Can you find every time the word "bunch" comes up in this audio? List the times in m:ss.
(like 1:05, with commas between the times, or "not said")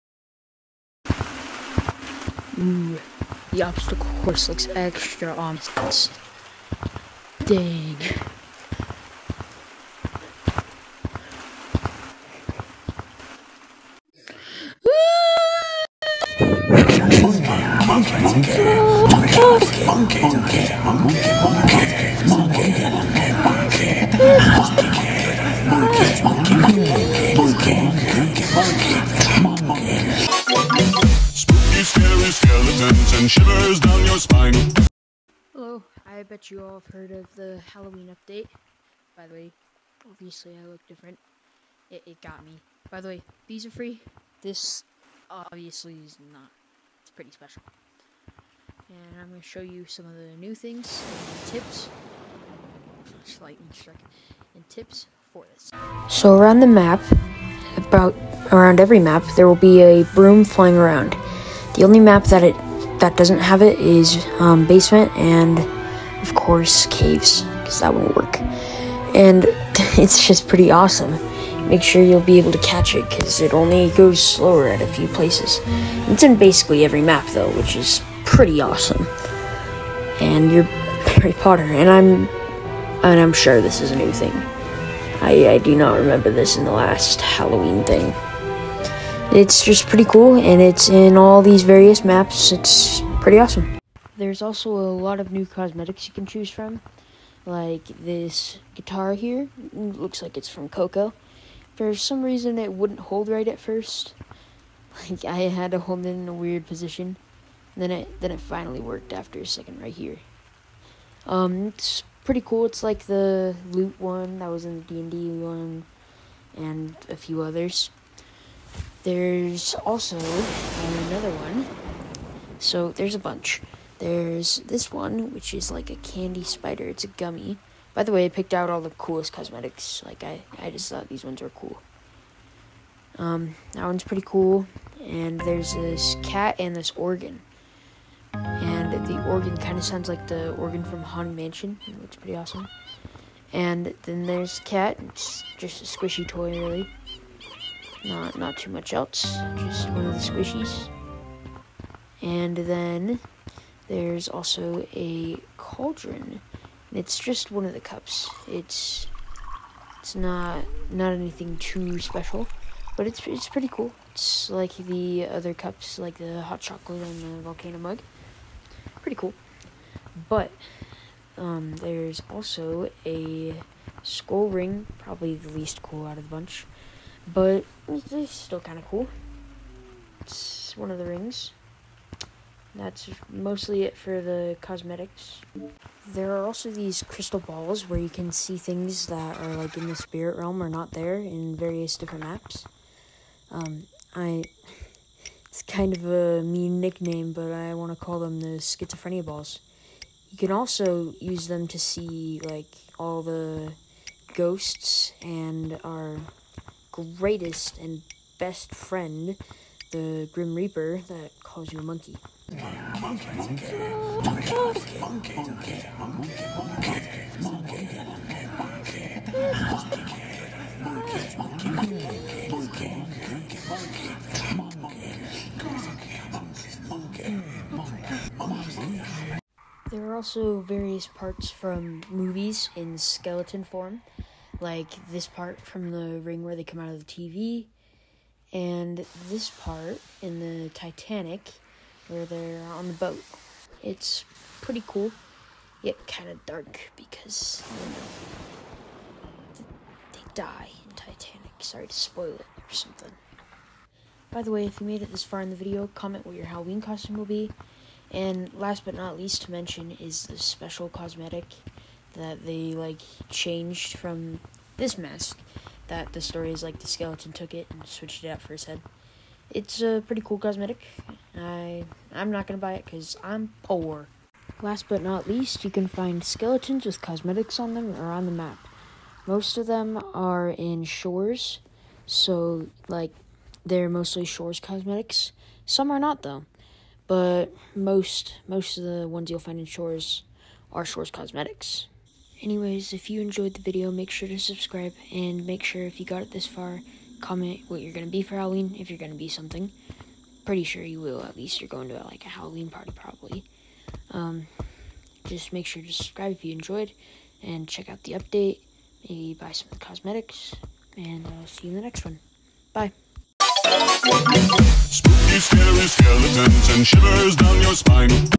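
2:03, 2:56.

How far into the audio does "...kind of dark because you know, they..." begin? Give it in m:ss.
4:06.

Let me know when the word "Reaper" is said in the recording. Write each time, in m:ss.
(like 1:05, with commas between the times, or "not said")
3:30.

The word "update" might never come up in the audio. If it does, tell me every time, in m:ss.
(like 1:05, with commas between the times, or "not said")
0:38, 5:08.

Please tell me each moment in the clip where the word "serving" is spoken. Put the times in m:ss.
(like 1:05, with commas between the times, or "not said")
not said.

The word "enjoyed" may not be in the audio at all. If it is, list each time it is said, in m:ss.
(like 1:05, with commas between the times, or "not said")
4:53, 5:06.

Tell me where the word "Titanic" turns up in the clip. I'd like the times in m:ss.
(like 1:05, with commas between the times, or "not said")
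4:00, 4:10.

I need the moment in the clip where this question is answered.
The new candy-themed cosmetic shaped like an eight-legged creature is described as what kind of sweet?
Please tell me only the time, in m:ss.
2:07.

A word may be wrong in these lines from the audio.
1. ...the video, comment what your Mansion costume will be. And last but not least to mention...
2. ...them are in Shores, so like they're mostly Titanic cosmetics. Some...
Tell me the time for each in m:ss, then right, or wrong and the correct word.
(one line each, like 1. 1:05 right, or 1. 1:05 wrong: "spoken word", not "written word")
1. 4:15 wrong: "Halloween", not "Mansion"
2. 4:39 wrong: "Shores", not "Titanic".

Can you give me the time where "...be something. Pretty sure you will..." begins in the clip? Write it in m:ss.
4:59.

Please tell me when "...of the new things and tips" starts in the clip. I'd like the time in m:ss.
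0:50.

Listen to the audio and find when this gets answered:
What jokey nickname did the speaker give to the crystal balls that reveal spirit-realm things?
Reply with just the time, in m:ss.
3:18.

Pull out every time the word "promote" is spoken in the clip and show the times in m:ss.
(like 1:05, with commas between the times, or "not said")
not said.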